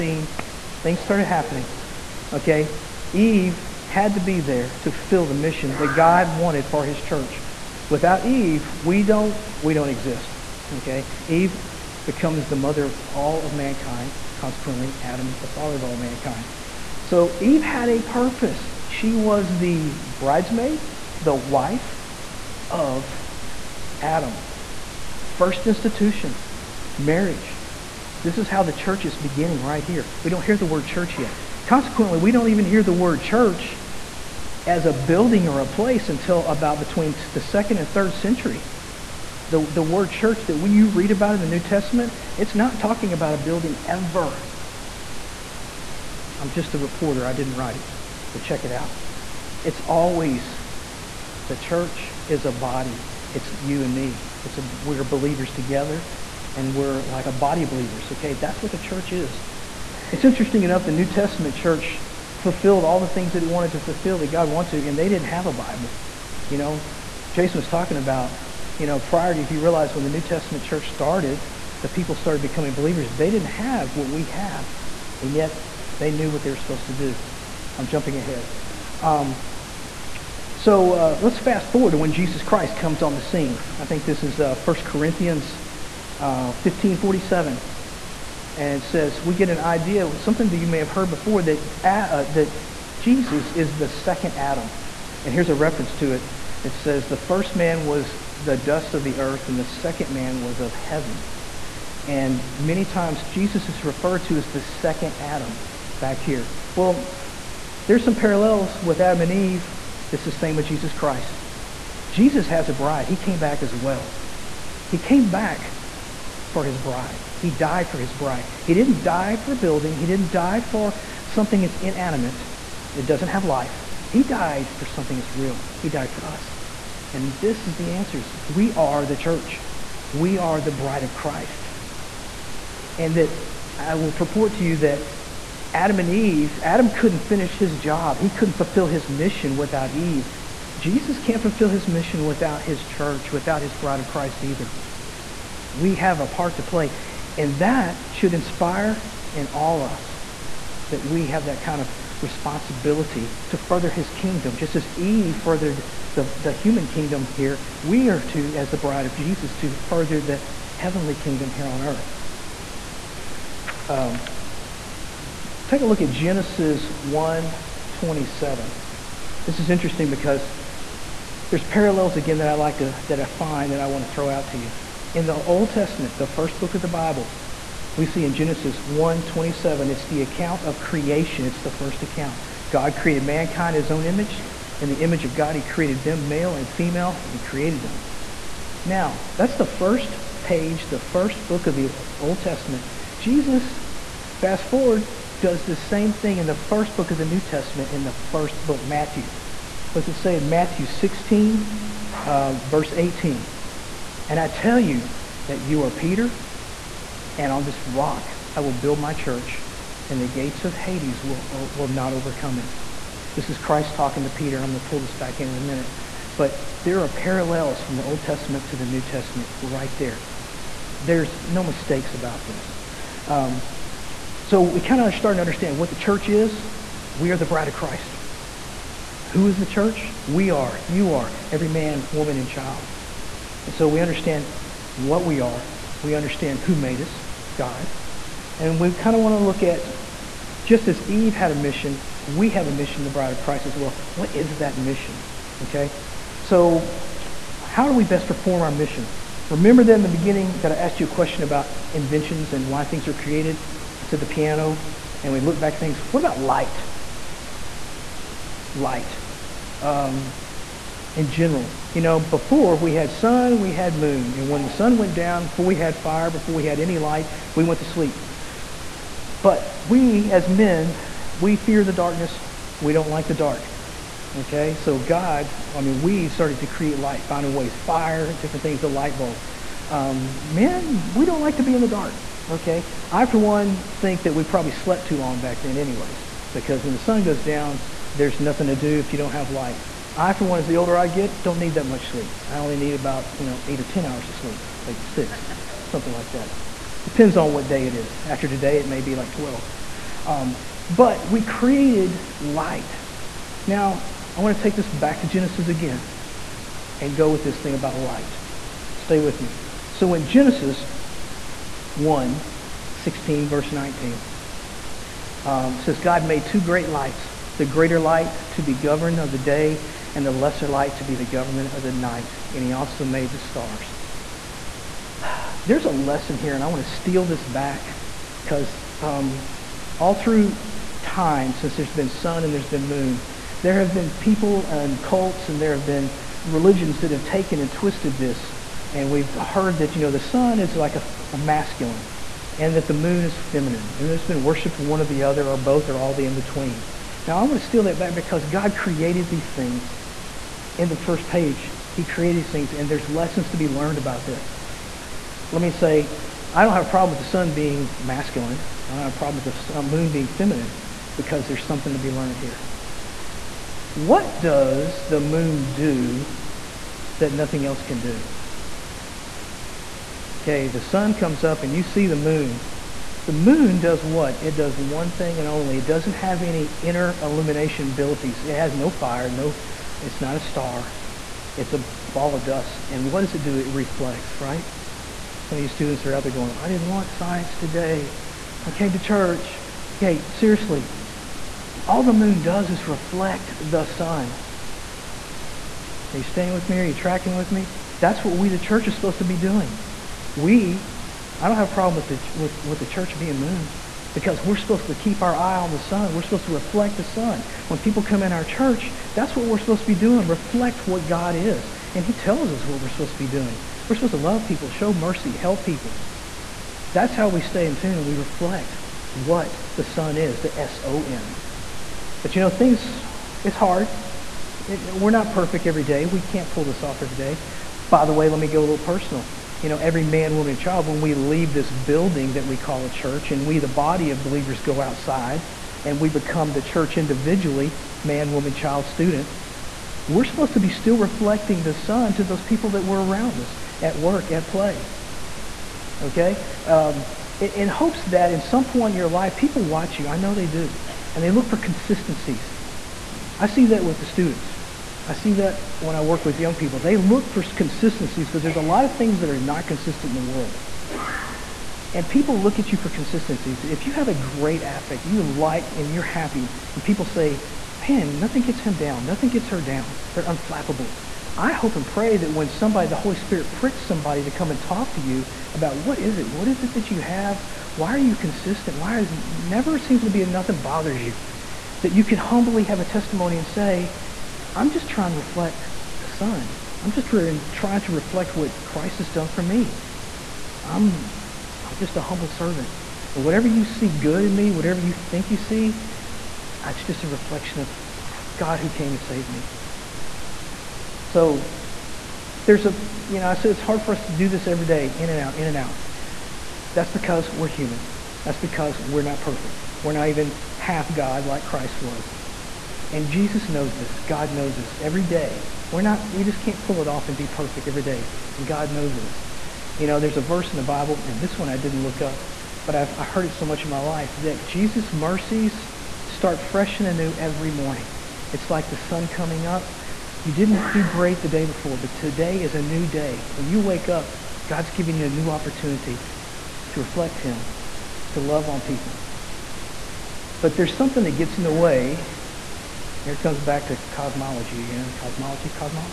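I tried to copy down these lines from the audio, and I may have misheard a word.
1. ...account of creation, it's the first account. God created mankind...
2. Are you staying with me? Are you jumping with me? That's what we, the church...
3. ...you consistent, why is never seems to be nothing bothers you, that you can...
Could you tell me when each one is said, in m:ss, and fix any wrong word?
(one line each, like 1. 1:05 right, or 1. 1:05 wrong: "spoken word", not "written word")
1. 3:00 right
2. 6:36 wrong: "tracking", not "jumping"
3. 7:57 right.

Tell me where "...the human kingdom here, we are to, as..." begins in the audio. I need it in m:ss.
2:36.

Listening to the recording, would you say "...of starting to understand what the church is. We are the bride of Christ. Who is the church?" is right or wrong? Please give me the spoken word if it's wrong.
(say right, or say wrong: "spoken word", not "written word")
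right.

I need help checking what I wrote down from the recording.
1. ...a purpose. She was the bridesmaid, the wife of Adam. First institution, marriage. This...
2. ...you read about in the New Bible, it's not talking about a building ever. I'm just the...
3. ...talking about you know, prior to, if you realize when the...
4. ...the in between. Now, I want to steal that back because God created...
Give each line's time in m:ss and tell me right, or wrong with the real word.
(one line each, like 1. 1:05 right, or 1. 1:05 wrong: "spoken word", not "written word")
1. 0:17 right
2. 0:40 wrong: "Testament", not "Bible"
3. 1:07 right
4. 5:46 right.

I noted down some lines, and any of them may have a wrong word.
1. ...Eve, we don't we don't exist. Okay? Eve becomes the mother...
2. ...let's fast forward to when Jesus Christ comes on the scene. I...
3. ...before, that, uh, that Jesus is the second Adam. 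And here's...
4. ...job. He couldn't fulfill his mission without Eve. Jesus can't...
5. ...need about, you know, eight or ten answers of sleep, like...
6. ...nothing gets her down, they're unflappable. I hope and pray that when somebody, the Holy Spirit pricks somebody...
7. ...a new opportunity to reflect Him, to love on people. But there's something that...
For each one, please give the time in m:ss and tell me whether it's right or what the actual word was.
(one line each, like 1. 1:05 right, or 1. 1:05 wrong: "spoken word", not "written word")
1. 0:08 right
2. 1:21 right
3. 1:31 right
4. 2:17 right
5. 4:52 wrong: "hours", not "answers"
6. 7:49 right
7. 8:55 right.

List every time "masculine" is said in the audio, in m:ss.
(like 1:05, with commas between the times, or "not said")
5:41, 5:57.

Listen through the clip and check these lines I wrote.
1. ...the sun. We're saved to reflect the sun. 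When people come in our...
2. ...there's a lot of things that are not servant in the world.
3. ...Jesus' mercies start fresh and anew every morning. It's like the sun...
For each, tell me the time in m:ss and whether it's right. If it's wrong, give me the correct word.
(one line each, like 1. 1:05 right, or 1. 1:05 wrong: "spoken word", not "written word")
1. 6:45 wrong: "supposed", not "saved"
2. 7:38 wrong: "consistent", not "servant"
3. 8:44 right.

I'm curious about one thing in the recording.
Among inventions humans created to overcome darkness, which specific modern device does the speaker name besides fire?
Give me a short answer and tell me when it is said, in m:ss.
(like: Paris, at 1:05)
the light bulb, at 4:38.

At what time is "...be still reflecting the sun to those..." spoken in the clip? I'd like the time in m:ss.
7:20.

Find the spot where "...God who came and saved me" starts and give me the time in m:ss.
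8:18.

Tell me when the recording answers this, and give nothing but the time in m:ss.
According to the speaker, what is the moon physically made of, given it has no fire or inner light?
6:21.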